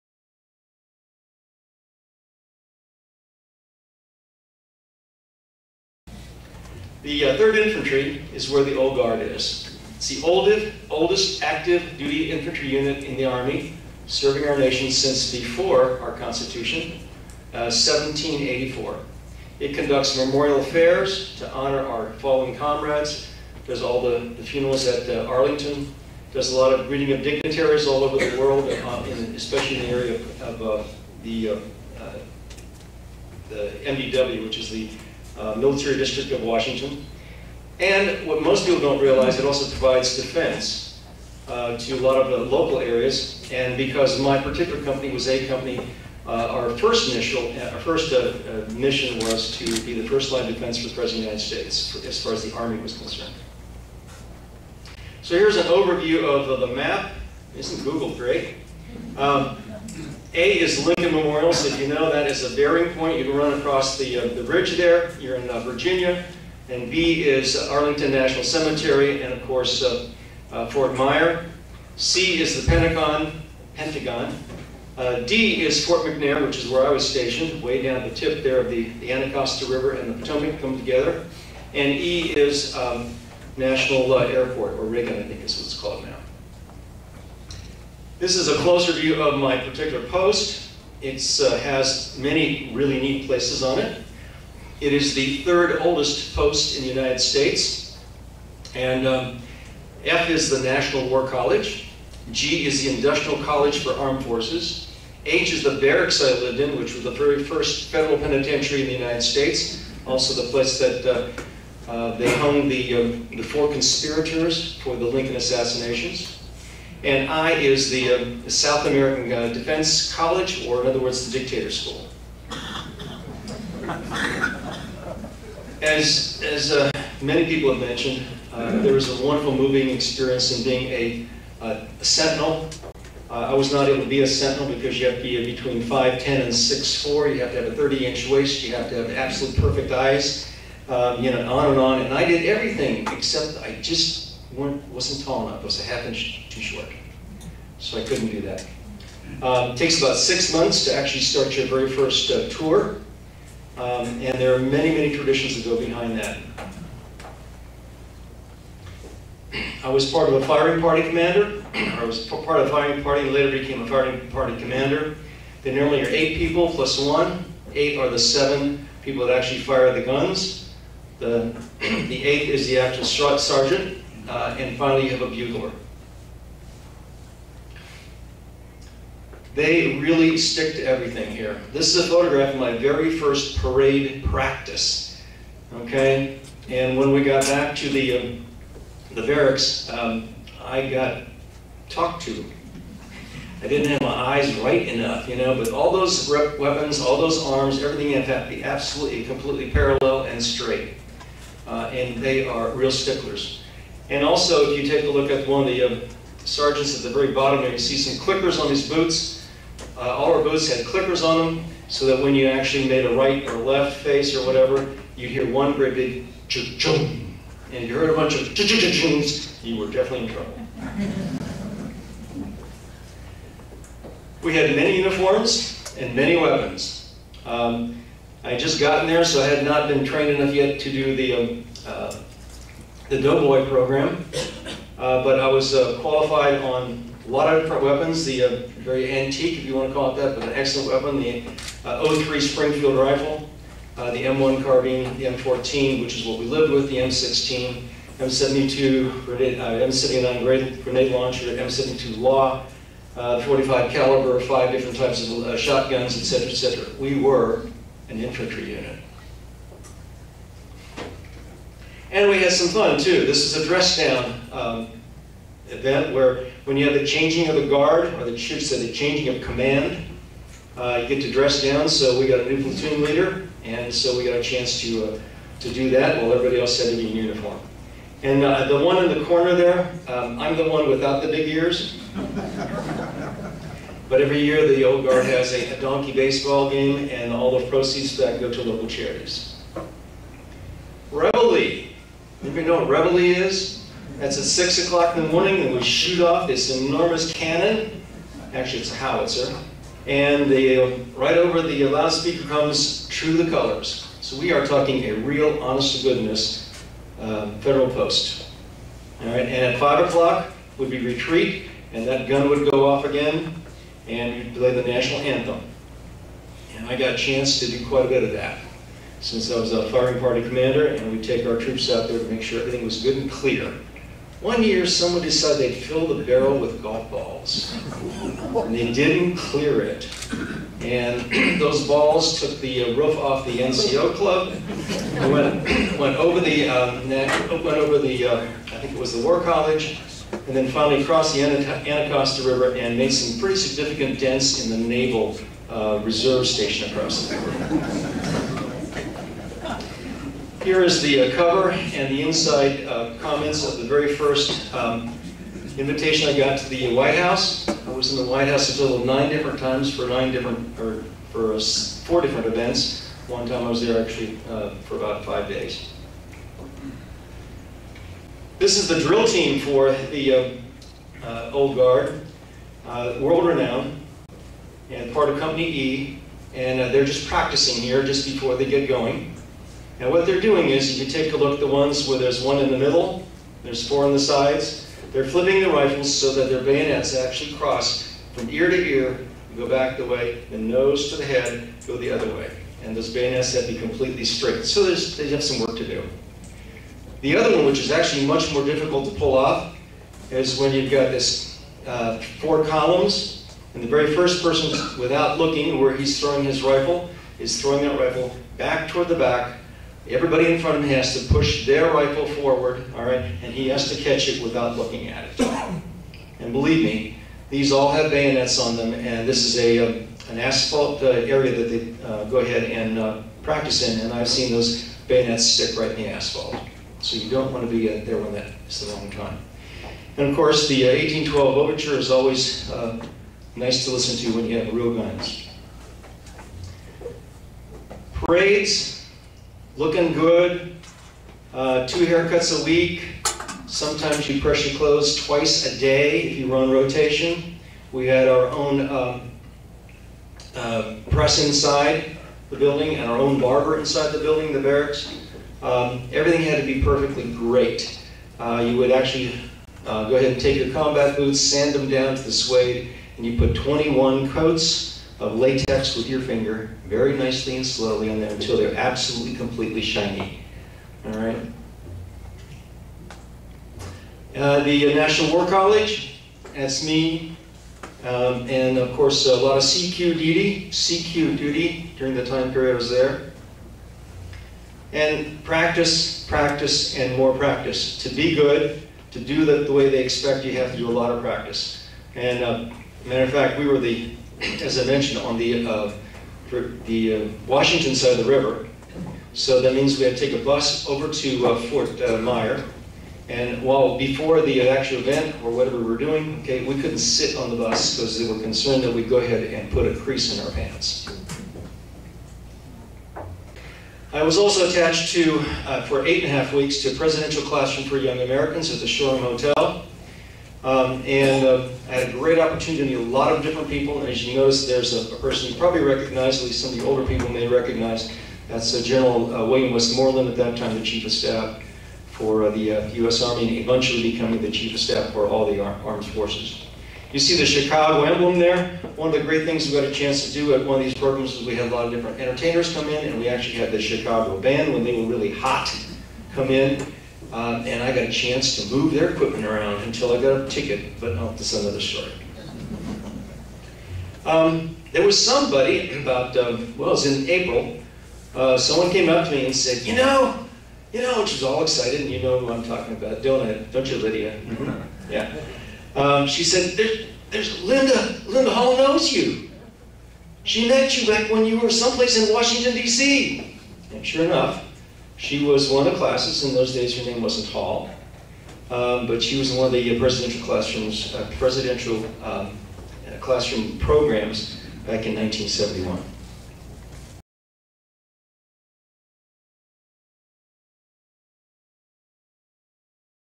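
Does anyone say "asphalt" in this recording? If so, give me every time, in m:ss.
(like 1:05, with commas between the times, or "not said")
7:00, 7:06.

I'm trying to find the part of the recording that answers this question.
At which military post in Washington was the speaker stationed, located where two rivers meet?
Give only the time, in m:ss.
1:15.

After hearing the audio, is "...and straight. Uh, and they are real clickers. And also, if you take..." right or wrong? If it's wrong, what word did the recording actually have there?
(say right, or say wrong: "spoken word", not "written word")
wrong: "sticklers", not "clickers".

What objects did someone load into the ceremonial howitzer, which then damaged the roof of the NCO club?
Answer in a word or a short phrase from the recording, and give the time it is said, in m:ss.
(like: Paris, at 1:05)
golf balls, at 5:26.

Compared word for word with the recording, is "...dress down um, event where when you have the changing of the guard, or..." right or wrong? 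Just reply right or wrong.
right.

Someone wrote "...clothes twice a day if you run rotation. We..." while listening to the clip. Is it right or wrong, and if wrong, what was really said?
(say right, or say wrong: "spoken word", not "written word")
right.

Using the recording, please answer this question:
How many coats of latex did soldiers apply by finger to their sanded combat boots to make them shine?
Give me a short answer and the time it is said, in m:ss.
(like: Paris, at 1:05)
21, at 7:43.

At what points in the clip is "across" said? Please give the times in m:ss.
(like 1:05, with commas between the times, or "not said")
1:03, 5:46.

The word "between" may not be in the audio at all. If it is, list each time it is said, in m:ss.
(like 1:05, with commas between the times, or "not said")
2:15.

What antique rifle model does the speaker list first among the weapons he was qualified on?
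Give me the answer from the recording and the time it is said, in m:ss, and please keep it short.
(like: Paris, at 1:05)
03 Springfield, at 4:02.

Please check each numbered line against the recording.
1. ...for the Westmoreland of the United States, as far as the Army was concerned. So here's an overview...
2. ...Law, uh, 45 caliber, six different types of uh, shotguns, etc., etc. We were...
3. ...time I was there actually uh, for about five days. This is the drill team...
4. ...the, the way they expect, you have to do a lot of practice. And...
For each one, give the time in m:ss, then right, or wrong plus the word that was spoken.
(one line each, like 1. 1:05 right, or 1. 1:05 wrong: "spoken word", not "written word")
1. 0:50 wrong: "President", not "Westmoreland"
2. 4:12 wrong: "five", not "six"
3. 6:03 right
4. 8:09 right.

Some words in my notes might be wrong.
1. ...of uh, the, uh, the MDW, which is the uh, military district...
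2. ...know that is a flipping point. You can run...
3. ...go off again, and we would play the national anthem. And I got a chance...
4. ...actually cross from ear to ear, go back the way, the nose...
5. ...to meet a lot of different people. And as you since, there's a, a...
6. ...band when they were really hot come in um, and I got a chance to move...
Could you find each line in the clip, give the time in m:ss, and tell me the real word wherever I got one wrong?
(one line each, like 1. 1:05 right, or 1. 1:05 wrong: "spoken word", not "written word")
1. 0:30 right
2. 1:01 wrong: "bearing", not "flipping"
3. 5:12 right
4. 6:27 right
5. 8:42 wrong: "notice", not "since"
6. 9:04 right.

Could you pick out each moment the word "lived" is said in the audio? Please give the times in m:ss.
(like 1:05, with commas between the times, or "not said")
1:46, 4:06.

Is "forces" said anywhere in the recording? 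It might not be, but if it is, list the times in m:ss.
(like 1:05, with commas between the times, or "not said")
1:44, 8:56.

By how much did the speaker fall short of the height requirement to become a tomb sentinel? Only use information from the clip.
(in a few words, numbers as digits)
a half inch.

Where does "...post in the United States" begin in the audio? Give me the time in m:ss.
1:36.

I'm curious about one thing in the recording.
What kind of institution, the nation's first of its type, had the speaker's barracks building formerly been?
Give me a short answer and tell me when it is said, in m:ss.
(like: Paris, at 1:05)
federal penitentiary, at 1:47.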